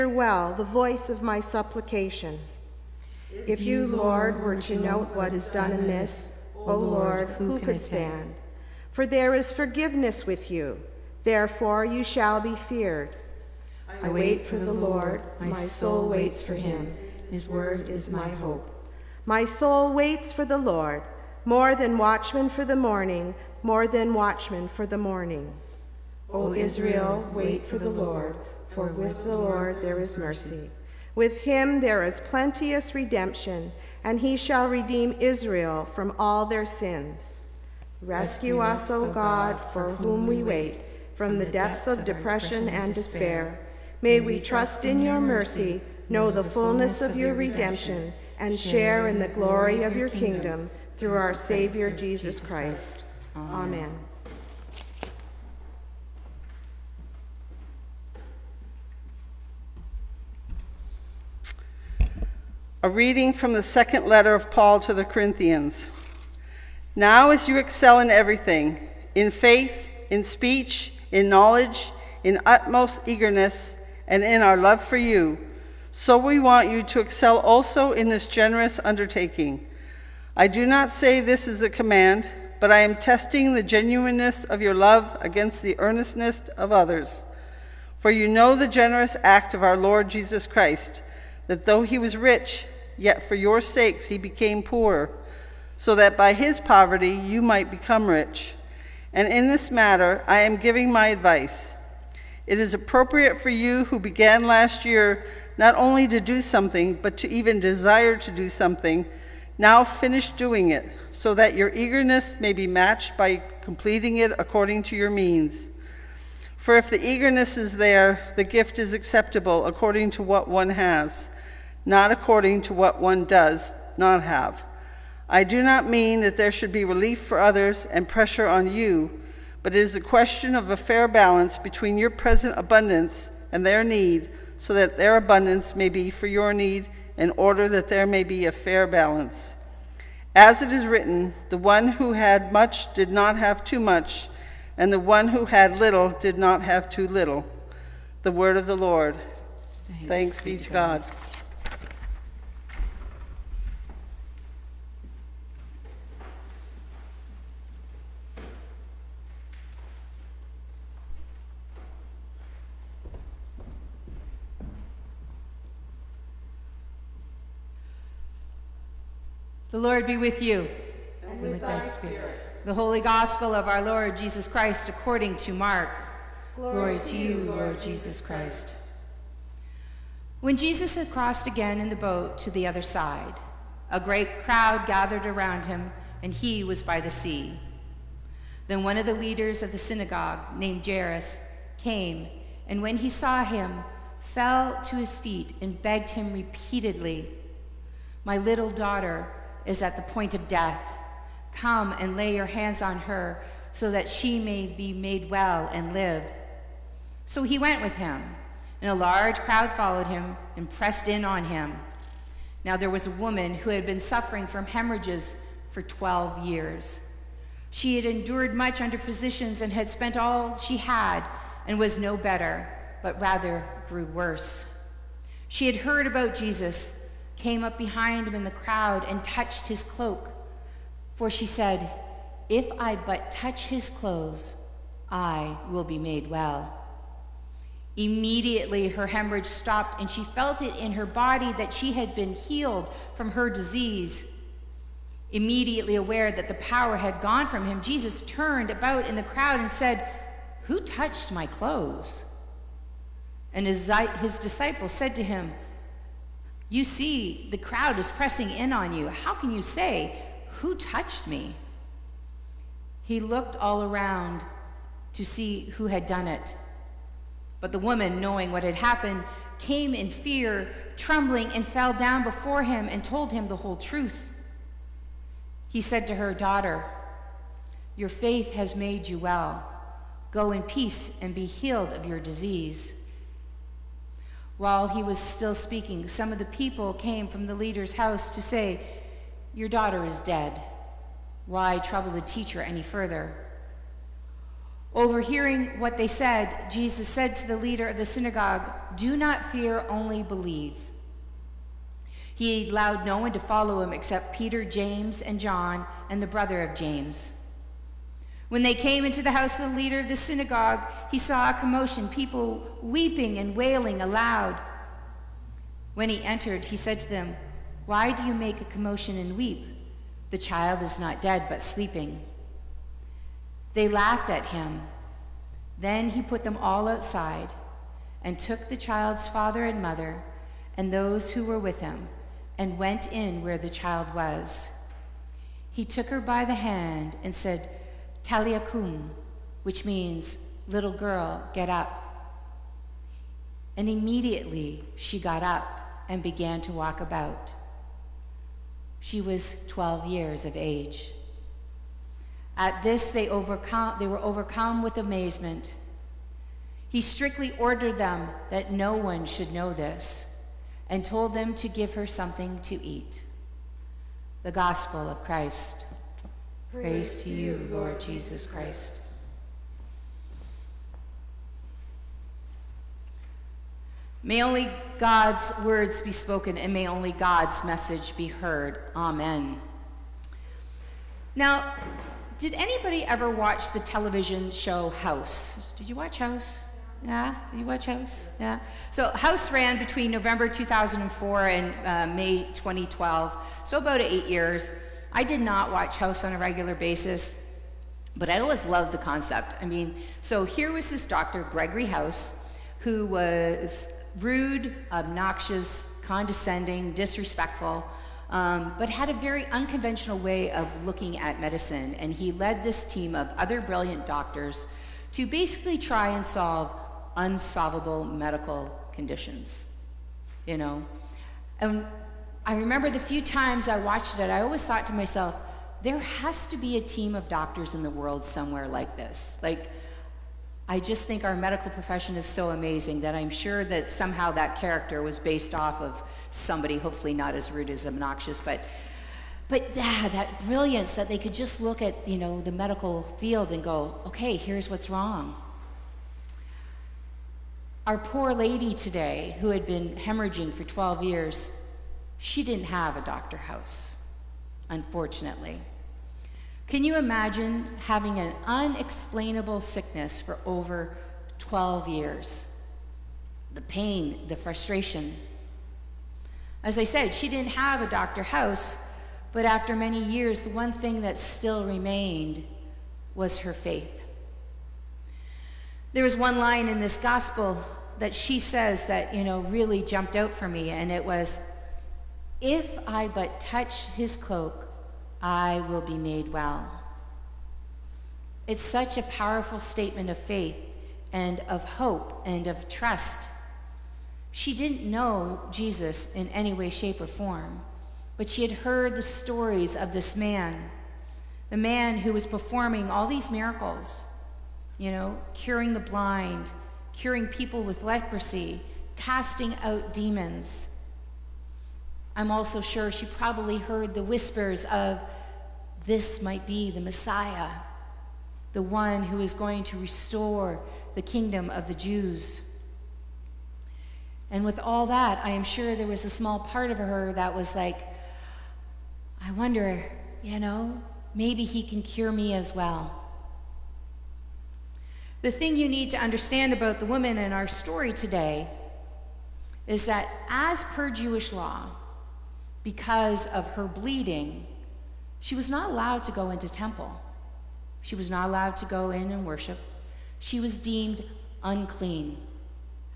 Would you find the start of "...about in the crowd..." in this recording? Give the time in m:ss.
4:08.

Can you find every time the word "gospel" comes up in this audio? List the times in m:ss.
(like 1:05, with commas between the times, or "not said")
2:53, 6:04, 7:56.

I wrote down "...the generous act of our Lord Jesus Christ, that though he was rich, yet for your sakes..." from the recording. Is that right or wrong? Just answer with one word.
right.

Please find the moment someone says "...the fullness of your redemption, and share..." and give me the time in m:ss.
0:46.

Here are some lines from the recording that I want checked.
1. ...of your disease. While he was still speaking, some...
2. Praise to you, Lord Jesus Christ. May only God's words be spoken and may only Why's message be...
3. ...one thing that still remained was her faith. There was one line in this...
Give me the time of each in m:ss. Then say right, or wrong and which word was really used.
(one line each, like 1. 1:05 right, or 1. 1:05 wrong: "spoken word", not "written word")
1. 4:41 right
2. 6:06 wrong: "God", not "Why"
3. 7:50 right.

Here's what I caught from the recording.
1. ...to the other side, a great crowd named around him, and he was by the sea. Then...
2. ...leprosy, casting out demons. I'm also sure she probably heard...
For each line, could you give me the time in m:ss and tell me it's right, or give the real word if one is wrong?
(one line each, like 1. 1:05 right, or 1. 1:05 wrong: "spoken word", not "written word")
1. 3:02 wrong: "gathered", not "named"
2. 8:27 right.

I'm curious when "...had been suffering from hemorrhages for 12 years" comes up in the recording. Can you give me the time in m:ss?
3:33.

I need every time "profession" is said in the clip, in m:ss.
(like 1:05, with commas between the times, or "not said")
7:11.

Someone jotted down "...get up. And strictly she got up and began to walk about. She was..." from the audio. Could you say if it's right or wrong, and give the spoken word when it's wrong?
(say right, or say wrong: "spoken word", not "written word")
wrong: "immediately", not "strictly".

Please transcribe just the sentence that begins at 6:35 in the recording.
I did not watch House on a regular basis, but I always loved the concept.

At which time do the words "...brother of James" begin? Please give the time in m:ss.
5:06.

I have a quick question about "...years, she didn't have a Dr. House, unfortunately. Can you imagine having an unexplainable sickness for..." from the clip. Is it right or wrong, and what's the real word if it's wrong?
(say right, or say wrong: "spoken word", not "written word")
right.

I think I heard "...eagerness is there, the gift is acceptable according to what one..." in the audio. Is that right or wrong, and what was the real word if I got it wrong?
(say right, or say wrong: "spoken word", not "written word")
right.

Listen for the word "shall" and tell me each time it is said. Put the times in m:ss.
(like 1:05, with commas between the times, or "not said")
0:12, 0:34.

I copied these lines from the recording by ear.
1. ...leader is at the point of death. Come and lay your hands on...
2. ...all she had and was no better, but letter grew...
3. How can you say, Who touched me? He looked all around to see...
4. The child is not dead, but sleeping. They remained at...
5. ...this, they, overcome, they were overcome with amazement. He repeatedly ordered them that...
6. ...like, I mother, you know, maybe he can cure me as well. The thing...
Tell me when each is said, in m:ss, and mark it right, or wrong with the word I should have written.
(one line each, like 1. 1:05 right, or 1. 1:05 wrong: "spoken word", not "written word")
1. 3:18 wrong: "daughter", not "leader"
2. 3:40 wrong: "rather", not "letter"
3. 4:19 right
4. 5:20 wrong: "laughed", not "remained"
5. 5:52 wrong: "strictly", not "repeatedly"
6. 8:47 wrong: "wonder", not "mother".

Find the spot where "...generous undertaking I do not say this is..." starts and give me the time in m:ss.
1:18.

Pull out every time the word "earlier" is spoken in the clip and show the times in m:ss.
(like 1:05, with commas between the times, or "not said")
not said.